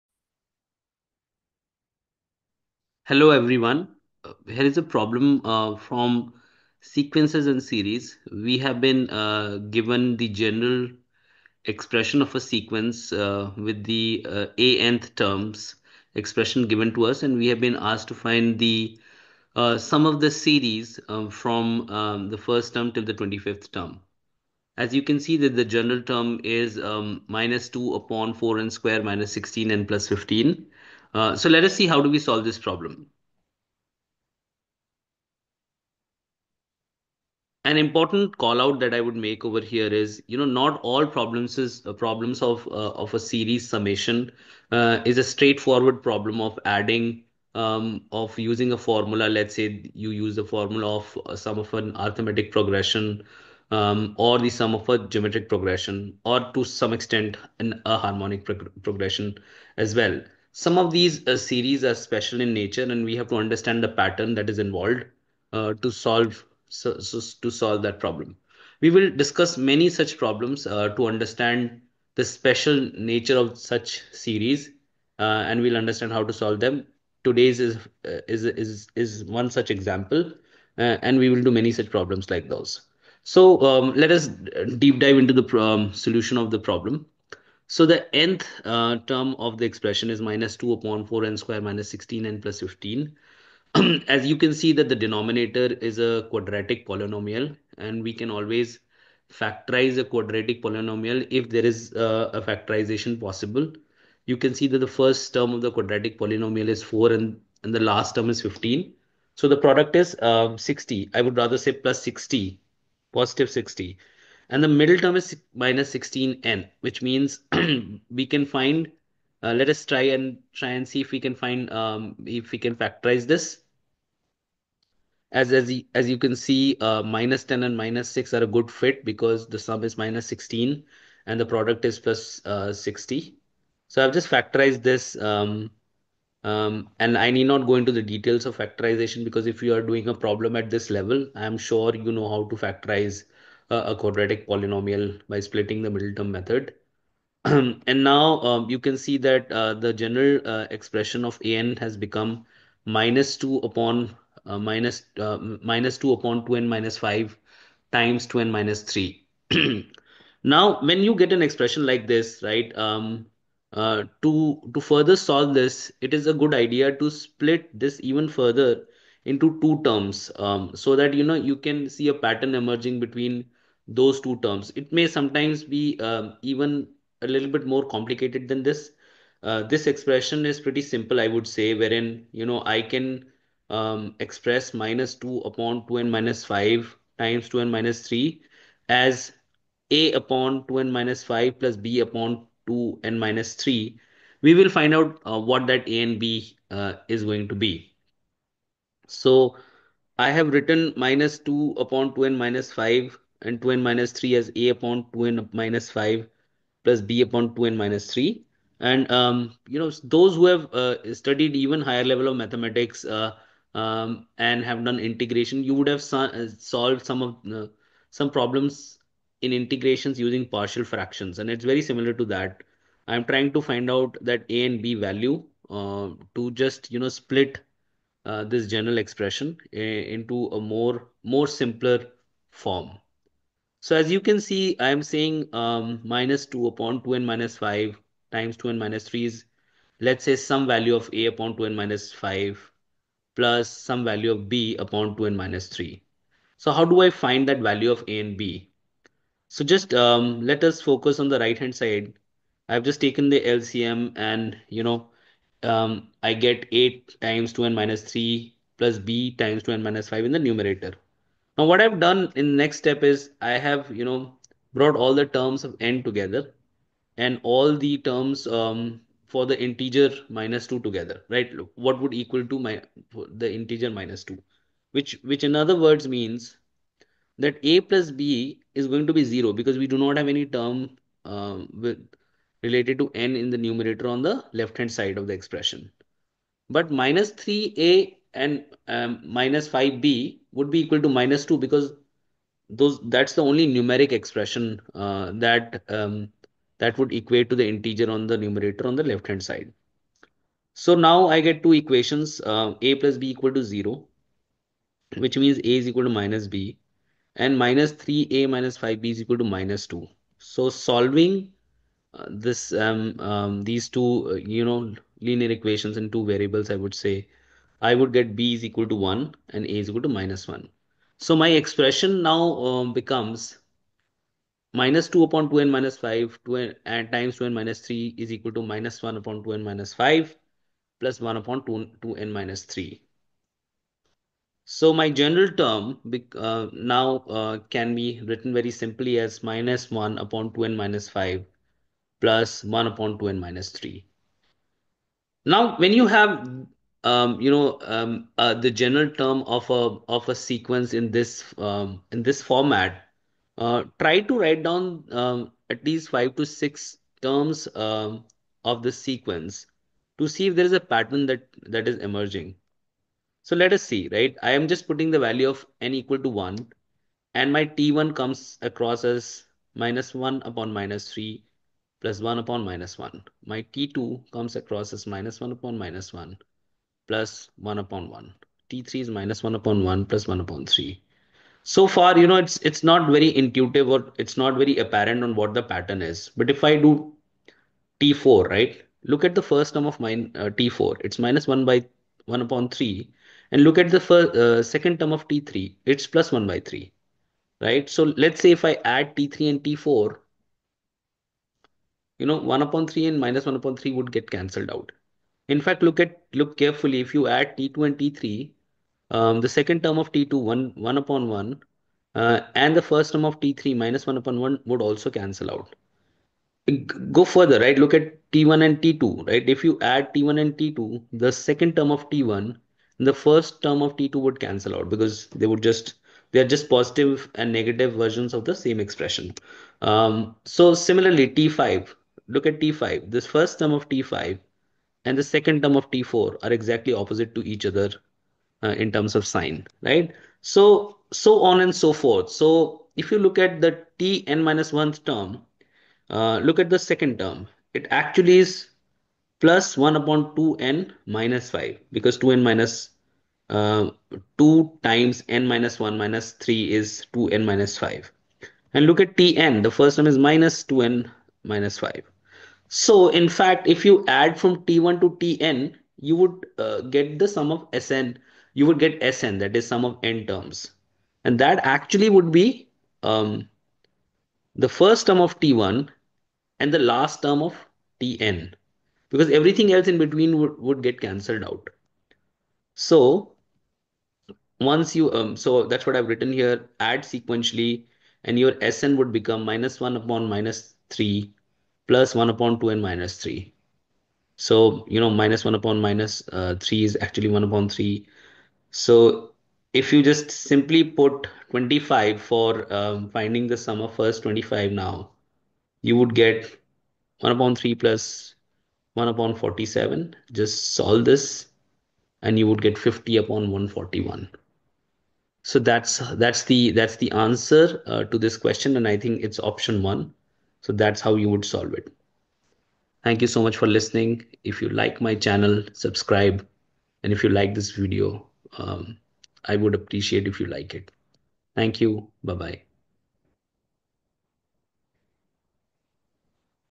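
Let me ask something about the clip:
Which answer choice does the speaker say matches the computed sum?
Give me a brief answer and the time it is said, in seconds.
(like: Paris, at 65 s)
Option 1, at 519 s.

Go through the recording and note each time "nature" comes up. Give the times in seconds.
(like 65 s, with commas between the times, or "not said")
62 s, 72 s.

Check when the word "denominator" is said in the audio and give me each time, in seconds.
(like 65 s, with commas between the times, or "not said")
95 s.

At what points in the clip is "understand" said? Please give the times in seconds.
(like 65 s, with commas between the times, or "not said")
63 s, 71 s, 75 s.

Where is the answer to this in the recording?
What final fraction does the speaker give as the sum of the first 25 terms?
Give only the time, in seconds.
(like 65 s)
512 s.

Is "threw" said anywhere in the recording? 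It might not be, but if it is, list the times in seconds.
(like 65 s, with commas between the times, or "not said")
not said.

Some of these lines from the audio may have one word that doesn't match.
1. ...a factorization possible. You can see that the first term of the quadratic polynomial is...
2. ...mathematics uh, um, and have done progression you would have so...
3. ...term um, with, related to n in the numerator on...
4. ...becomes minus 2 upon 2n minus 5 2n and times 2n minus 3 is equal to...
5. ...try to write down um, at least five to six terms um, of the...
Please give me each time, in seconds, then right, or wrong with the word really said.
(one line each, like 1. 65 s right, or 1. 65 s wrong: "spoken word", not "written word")
1. 102 s right
2. 212 s wrong: "integration", not "progression"
3. 280 s right
4. 322 s right
5. 353 s right.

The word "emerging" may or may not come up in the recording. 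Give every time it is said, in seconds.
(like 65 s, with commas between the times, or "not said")
172 s, 361 s.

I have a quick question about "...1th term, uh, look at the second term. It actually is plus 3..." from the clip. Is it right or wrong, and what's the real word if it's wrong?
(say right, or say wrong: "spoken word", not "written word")
wrong: "1", not "3".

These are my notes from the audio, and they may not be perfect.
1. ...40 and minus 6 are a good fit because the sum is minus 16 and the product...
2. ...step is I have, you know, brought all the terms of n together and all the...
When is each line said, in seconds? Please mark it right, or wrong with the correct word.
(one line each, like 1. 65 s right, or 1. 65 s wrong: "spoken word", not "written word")
1. 127 s wrong: "10", not "40"
2. 262 s right.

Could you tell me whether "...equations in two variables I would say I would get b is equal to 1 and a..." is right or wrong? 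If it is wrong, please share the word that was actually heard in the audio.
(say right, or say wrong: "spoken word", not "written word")
right.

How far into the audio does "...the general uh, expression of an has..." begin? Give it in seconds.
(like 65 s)
149 s.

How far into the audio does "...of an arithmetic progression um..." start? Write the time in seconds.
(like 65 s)
51 s.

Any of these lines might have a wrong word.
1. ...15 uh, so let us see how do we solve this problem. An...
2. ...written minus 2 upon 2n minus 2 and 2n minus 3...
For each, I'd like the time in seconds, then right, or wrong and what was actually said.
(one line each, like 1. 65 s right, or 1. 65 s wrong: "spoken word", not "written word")
1. 30 s right
2. 200 s wrong: "5", not "2".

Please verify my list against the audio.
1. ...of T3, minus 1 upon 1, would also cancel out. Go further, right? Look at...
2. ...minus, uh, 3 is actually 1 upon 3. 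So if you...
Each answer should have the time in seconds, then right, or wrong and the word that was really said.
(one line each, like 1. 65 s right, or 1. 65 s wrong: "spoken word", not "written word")
1. 413 s right
2. 495 s right.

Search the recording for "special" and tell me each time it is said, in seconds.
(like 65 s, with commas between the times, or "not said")
61 s, 72 s.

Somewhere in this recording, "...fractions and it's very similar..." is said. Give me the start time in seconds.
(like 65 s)
220 s.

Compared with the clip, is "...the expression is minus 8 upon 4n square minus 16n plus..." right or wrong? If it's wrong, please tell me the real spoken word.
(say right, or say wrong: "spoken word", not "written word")
wrong: "2", not "8".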